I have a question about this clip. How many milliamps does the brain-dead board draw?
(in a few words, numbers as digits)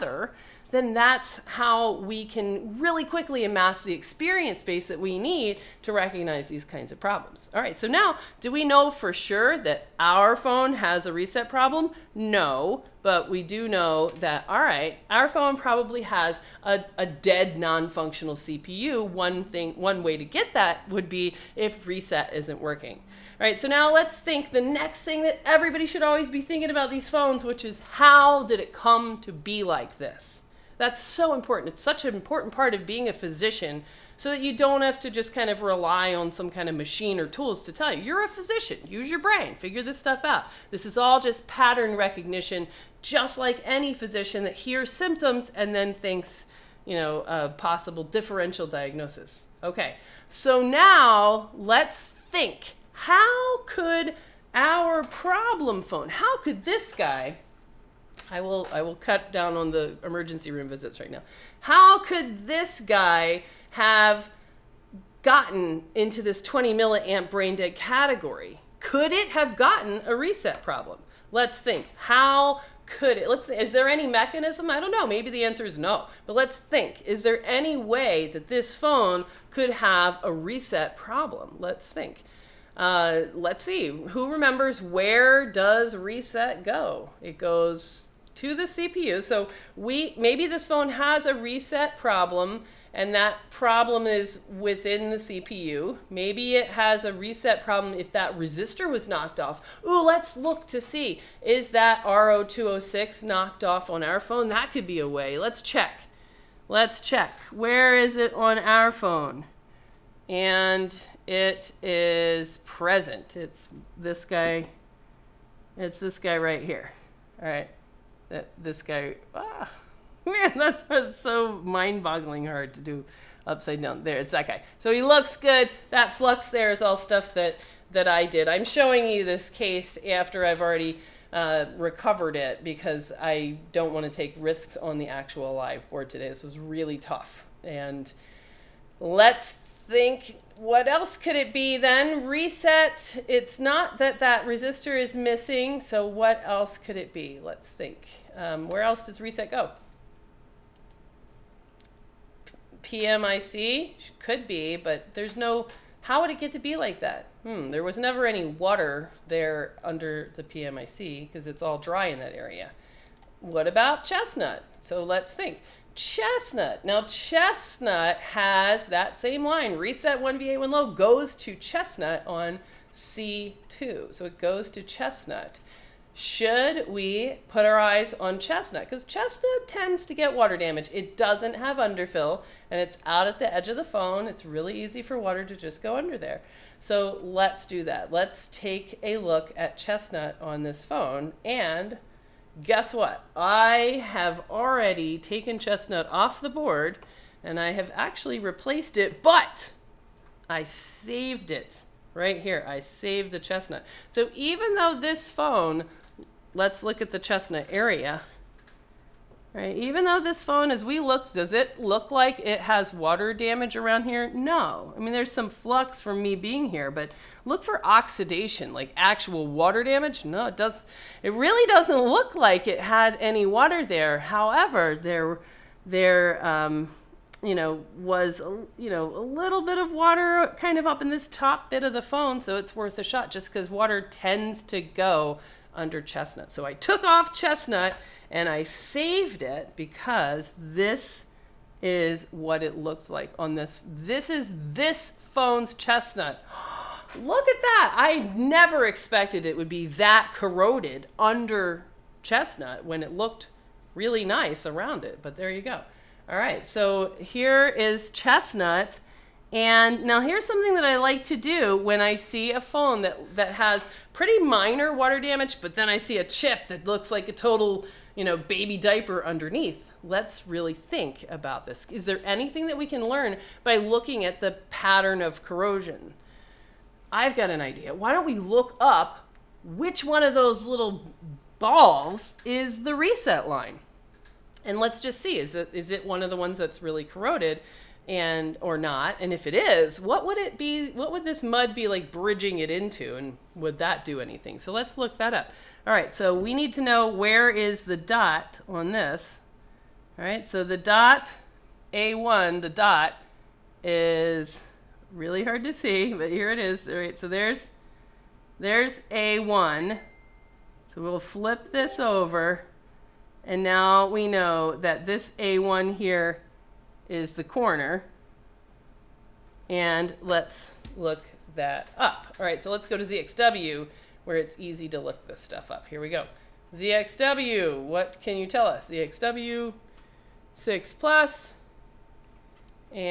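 20.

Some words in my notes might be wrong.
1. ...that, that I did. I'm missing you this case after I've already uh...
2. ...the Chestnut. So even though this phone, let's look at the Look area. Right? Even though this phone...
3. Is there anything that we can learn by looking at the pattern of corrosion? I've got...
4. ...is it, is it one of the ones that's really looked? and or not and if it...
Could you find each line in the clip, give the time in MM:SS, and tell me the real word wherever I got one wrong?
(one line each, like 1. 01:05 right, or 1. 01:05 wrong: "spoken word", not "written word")
1. 02:07 wrong: "showing", not "missing"
2. 03:23 wrong: "Chestnut", not "Look"
3. 04:31 right
4. 04:45 wrong: "corroded", not "looked".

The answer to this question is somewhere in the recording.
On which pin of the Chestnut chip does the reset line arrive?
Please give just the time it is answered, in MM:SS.
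02:52.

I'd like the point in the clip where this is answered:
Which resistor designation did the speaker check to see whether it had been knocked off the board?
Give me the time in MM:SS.
01:42.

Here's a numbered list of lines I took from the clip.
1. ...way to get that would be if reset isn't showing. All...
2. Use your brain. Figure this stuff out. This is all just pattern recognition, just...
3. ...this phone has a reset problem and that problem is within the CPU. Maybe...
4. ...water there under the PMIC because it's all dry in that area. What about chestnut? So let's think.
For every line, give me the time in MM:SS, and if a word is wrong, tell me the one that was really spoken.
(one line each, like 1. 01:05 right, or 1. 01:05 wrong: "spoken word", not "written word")
1. 00:20 wrong: "working", not "showing"
2. 00:38 right
3. 01:30 right
4. 02:38 right.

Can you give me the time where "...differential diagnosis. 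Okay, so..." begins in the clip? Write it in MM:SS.
00:48.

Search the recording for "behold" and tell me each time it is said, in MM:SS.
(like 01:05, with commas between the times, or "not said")
not said.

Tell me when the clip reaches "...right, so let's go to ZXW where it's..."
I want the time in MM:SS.
05:22.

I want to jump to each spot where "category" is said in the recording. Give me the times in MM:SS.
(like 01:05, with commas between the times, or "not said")
01:07.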